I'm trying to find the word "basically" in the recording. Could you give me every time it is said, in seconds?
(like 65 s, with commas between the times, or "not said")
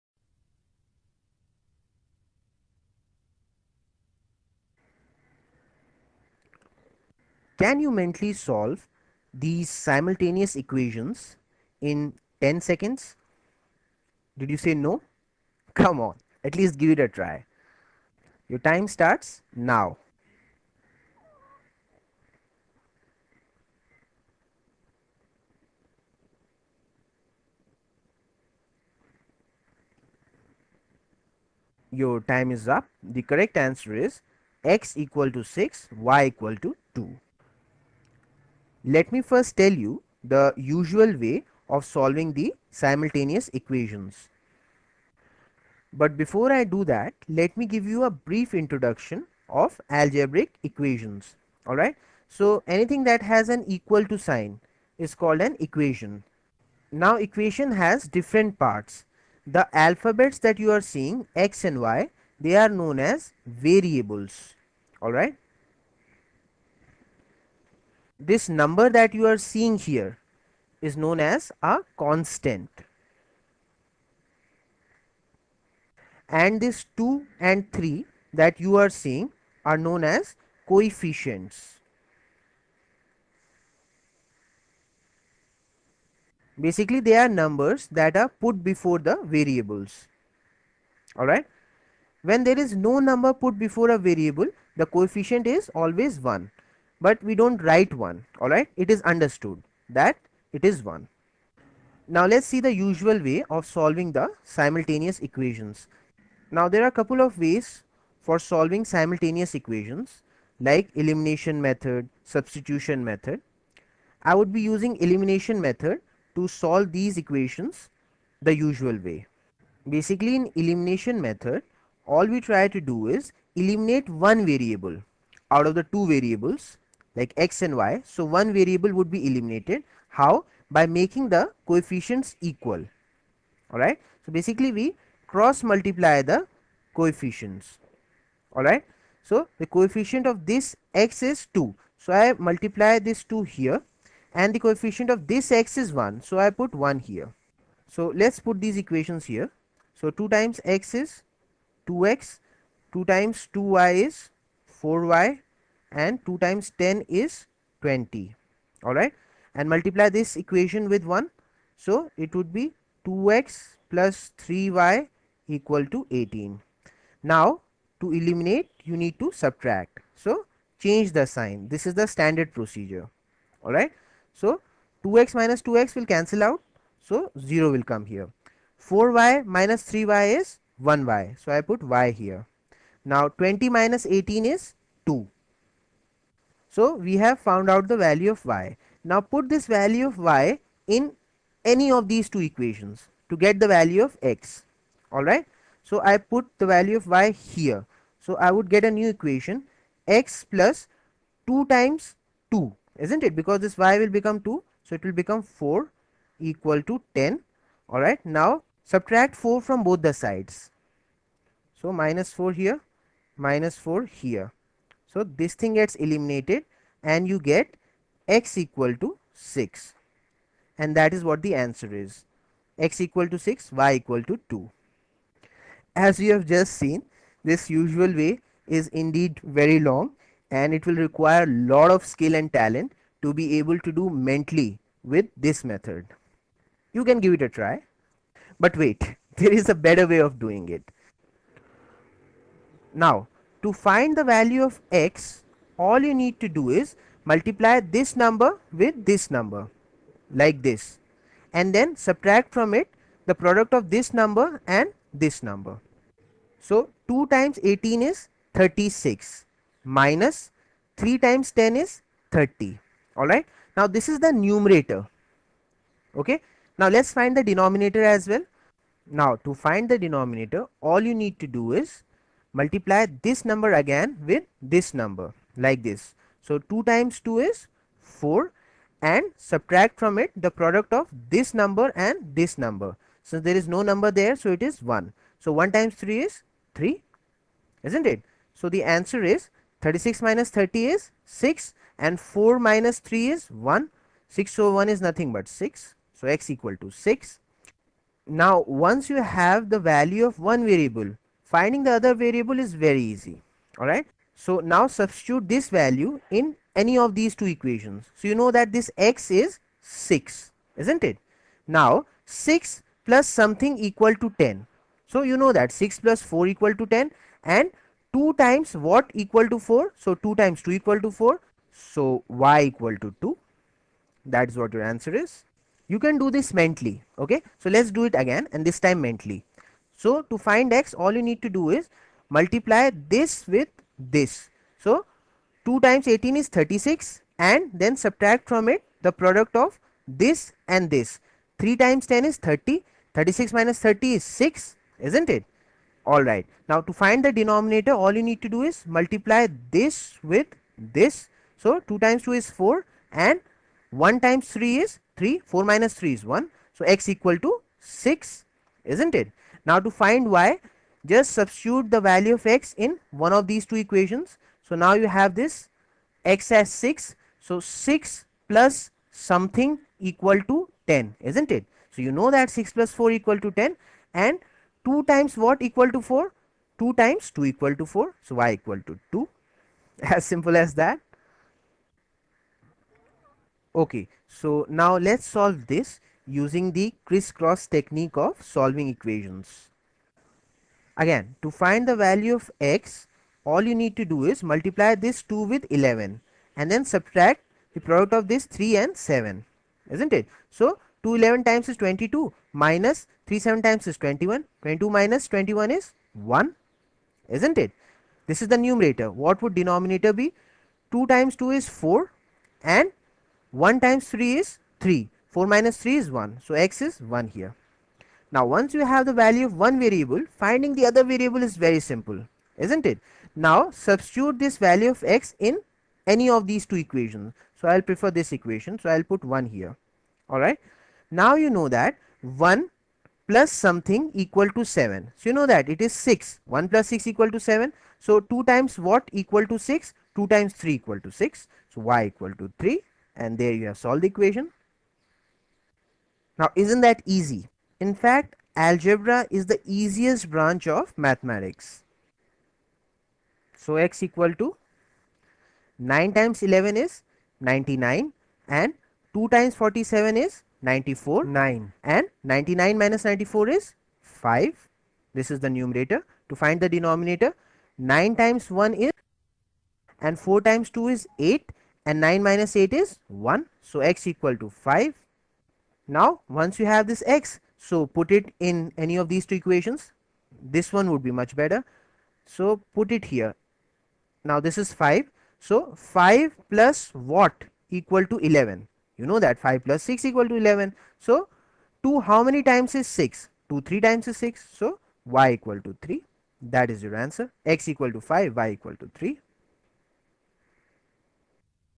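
86 s, 119 s, 134 s.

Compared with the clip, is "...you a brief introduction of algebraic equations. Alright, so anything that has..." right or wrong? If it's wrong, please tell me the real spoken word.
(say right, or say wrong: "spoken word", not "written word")
right.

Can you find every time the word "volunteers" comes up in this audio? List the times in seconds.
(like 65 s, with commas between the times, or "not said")
not said.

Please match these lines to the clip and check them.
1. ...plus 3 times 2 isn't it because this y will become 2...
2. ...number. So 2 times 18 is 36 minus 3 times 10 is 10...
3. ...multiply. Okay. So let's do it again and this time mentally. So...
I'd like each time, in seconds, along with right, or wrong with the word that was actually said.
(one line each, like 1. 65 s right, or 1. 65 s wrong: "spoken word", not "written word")
1. 200 s wrong: "2", not "3"
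2. 255 s wrong: "30", not "10"
3. 326 s wrong: "mentally", not "multiply".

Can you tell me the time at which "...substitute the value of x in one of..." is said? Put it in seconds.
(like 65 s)
361 s.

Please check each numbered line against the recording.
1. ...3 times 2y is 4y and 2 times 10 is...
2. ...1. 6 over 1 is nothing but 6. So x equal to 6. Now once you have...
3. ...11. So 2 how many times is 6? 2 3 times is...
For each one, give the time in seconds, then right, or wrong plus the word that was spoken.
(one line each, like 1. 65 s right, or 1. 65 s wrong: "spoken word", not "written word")
1. 152 s wrong: "2", not "3"
2. 293 s right
3. 490 s right.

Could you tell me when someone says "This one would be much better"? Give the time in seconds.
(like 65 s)
480 s.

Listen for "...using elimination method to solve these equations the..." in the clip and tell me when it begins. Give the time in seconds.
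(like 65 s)
114 s.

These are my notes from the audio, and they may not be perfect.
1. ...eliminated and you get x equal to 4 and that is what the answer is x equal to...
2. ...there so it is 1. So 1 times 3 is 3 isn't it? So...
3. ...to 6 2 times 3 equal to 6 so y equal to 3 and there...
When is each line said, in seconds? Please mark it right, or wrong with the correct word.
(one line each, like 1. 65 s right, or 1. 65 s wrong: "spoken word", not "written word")
1. 215 s wrong: "6", not "4"
2. 284 s right
3. 439 s right.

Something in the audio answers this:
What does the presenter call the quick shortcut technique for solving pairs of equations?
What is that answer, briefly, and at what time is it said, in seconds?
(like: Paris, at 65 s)
crisscross technique, at 387 s.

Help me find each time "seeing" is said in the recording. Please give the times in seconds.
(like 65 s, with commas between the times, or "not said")
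60 s, 69 s, 78 s.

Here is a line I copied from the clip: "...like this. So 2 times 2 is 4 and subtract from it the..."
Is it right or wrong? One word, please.
right.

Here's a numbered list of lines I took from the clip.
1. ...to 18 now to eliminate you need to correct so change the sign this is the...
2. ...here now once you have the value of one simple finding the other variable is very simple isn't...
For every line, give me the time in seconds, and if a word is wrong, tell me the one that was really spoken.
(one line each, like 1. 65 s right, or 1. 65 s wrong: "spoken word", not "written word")
1. 165 s wrong: "subtract", not "correct"
2. 417 s wrong: "variable", not "simple".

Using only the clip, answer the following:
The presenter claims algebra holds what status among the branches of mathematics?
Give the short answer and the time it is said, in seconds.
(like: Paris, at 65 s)
the easiest branch, at 449 s.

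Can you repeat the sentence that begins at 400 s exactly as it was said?
So, 2 11 times is 22 minus 3 7 times is 21, 22 minus 21 is 1, isn't it?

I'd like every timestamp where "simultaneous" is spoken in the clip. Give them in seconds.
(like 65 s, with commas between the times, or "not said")
9 s, 42 s, 104 s, 108 s.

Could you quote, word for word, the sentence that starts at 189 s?
Now put this value of y in any of these two equations to get the value of x.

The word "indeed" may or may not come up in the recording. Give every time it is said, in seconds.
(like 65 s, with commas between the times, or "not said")
228 s.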